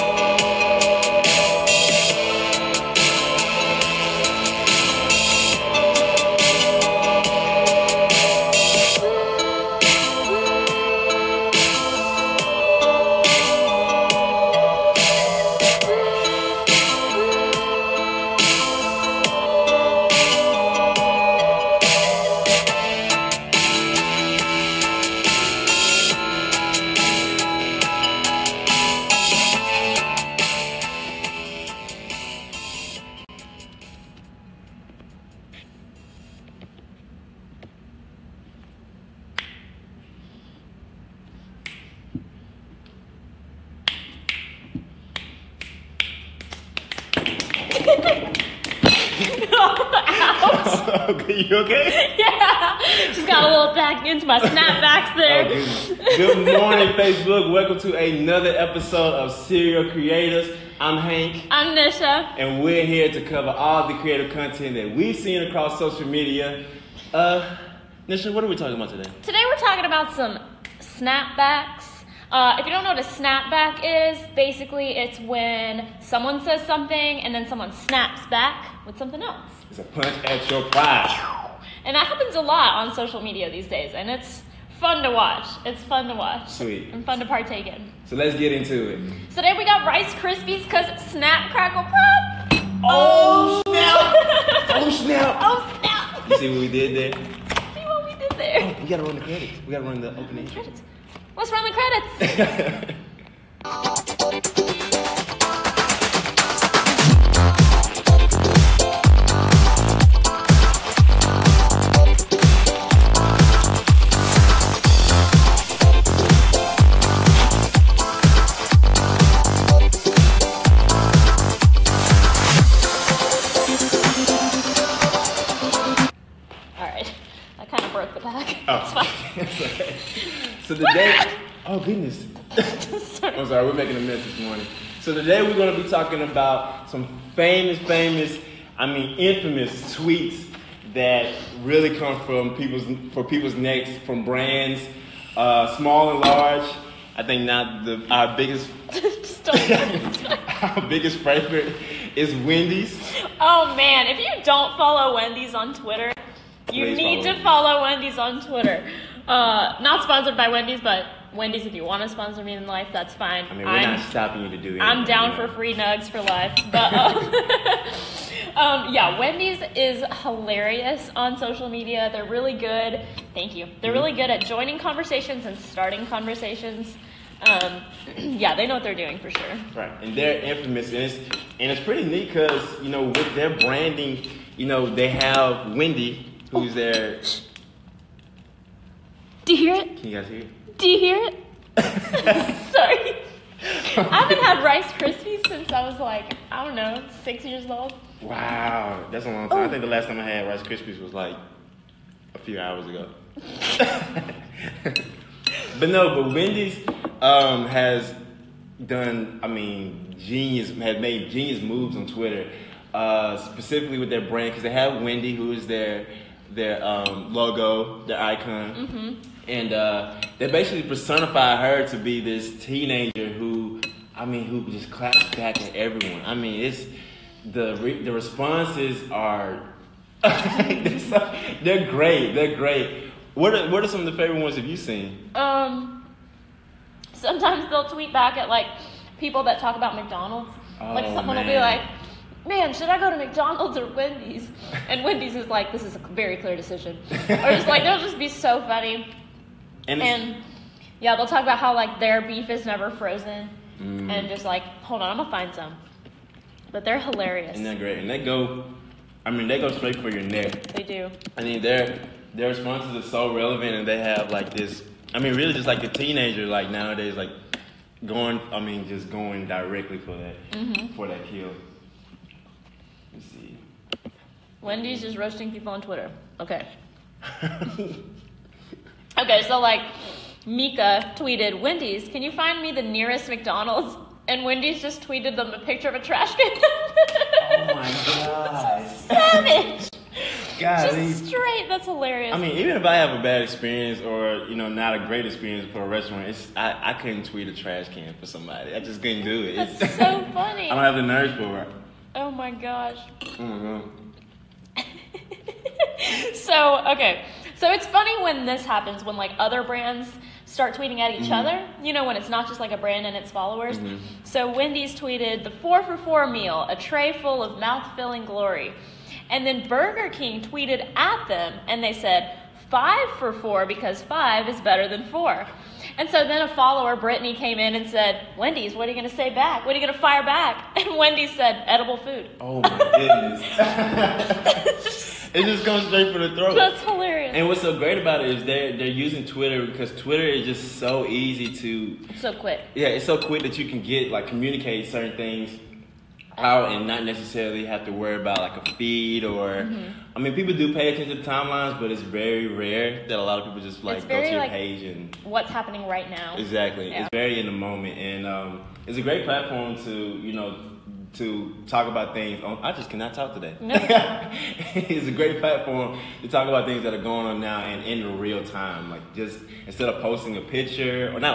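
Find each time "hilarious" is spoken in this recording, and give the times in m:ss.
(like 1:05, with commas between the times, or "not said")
2:50, 4:16, 4:51, 5:36.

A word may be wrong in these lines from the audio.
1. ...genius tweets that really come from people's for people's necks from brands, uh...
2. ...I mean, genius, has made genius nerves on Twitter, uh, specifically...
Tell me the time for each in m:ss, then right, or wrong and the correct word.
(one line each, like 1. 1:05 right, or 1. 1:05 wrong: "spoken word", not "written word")
1. 2:19 wrong: "infamous", not "genius"
2. 3:29 wrong: "moves", not "nerves".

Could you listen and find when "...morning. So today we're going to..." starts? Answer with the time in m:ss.
2:14.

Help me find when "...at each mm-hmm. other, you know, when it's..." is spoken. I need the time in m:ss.
5:10.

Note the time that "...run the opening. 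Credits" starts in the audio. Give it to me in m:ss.
1:39.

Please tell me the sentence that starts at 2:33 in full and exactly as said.
Oh man, if you don't follow Wendy's on Twitter, you Please need follow to follow Wendy's on Twitter.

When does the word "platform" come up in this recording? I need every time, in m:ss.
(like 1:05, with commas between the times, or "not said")
5:59, 6:05.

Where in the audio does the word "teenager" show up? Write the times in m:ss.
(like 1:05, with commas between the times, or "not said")
3:42, 4:25.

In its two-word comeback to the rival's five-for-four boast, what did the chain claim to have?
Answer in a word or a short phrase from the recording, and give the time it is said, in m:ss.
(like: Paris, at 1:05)
edible food, at 5:31.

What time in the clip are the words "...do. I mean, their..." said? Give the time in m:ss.
4:20.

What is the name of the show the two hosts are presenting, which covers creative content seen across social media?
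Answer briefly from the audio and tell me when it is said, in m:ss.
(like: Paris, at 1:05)
Cereal Creatives, at 0:59.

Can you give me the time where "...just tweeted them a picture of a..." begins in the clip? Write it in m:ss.
4:44.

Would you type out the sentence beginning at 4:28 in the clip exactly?
I mean, just going directly for that mm-hmm.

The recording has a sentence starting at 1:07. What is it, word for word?
Uh, Nisha, what are we talking about today?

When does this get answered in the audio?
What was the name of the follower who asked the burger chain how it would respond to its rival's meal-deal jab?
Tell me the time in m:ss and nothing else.
5:26.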